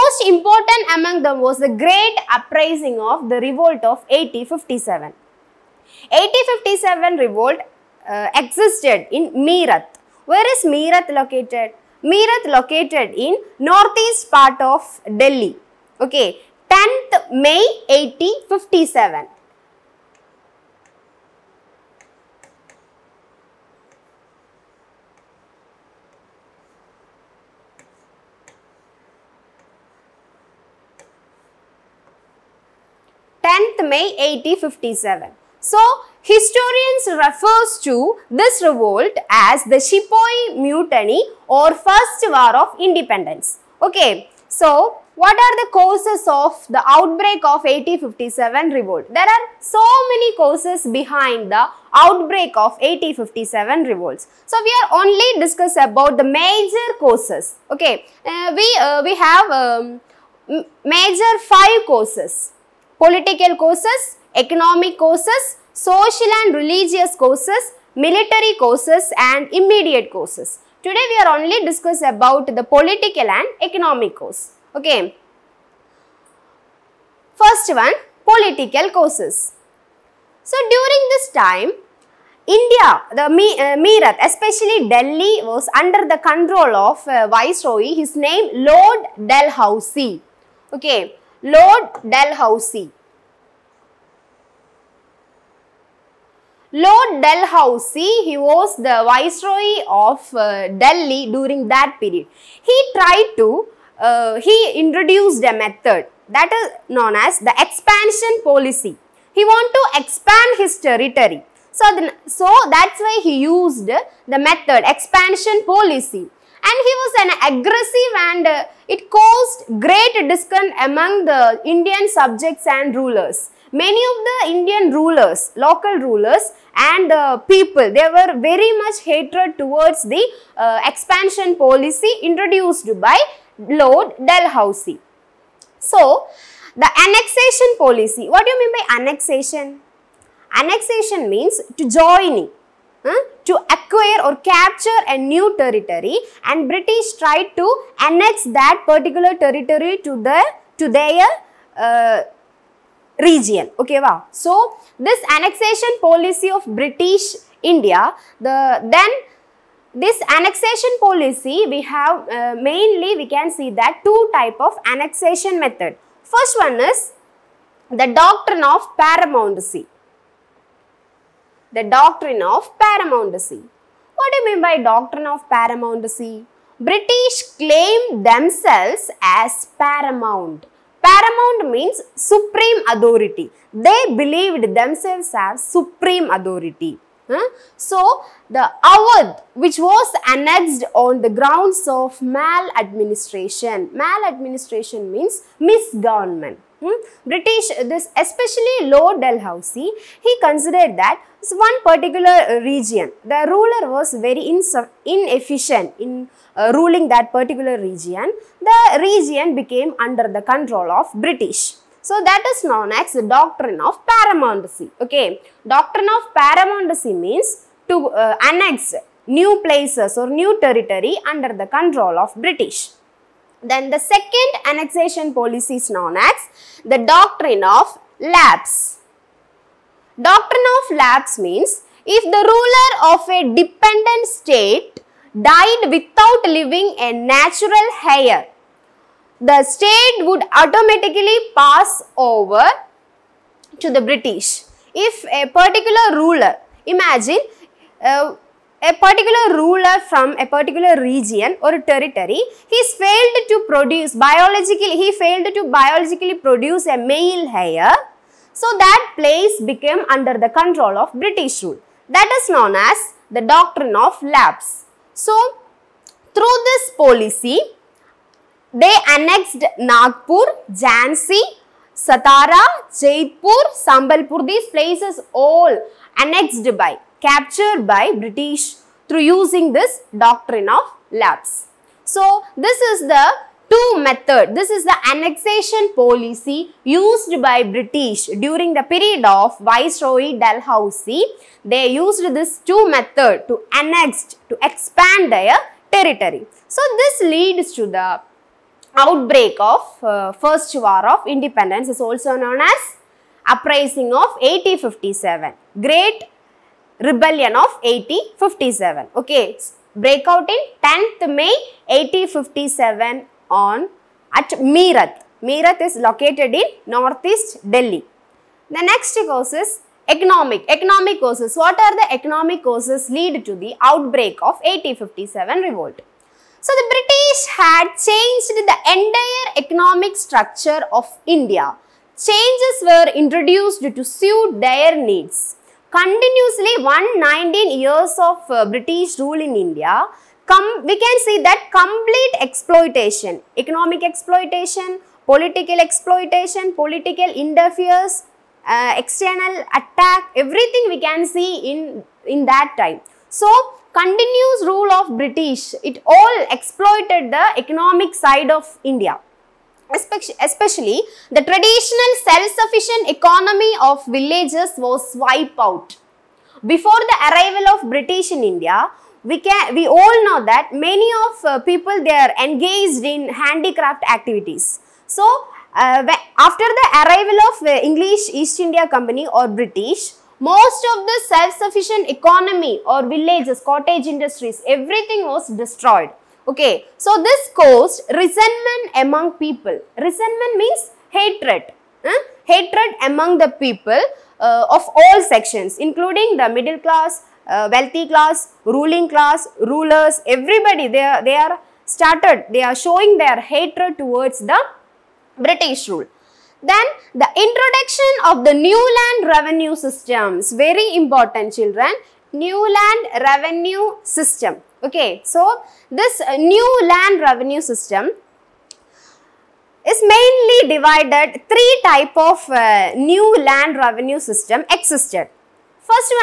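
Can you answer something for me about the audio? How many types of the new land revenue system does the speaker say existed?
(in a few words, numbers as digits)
3.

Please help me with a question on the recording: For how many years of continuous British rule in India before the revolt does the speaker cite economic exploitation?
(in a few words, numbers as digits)
119.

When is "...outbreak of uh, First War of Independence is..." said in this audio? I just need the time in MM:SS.
04:58.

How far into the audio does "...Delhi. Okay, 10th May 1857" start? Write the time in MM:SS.
00:15.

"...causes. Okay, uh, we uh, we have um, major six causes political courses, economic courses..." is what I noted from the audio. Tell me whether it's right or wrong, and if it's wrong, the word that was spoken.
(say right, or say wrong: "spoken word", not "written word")
wrong: "five", not "six".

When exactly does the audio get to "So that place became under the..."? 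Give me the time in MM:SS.
04:18.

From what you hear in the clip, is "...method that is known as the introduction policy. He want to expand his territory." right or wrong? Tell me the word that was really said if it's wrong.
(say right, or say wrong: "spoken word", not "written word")
wrong: "expansion", not "introduction".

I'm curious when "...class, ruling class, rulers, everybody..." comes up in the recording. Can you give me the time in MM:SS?
06:38.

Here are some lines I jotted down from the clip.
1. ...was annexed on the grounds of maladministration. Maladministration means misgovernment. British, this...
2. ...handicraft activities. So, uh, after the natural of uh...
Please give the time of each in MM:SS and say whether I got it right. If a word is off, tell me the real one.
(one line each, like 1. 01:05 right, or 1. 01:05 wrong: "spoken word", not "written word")
1. 03:09 right
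2. 06:13 wrong: "arrival", not "natural".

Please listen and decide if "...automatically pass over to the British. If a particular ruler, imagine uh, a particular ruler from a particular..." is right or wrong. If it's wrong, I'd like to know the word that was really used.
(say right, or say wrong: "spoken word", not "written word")
right.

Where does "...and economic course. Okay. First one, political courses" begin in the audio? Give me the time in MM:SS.
01:13.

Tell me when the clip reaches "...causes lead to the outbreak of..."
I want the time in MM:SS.
05:22.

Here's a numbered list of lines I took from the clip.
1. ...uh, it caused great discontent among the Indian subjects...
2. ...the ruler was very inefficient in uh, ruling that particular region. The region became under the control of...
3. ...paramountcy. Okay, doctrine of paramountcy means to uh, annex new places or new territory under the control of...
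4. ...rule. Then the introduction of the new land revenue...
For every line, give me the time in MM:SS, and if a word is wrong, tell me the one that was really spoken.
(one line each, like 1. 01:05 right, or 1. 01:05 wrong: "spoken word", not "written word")
1. 01:58 right
2. 03:23 right
3. 03:34 right
4. 06:45 right.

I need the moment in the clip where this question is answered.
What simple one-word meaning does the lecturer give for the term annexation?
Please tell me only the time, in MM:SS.
02:21.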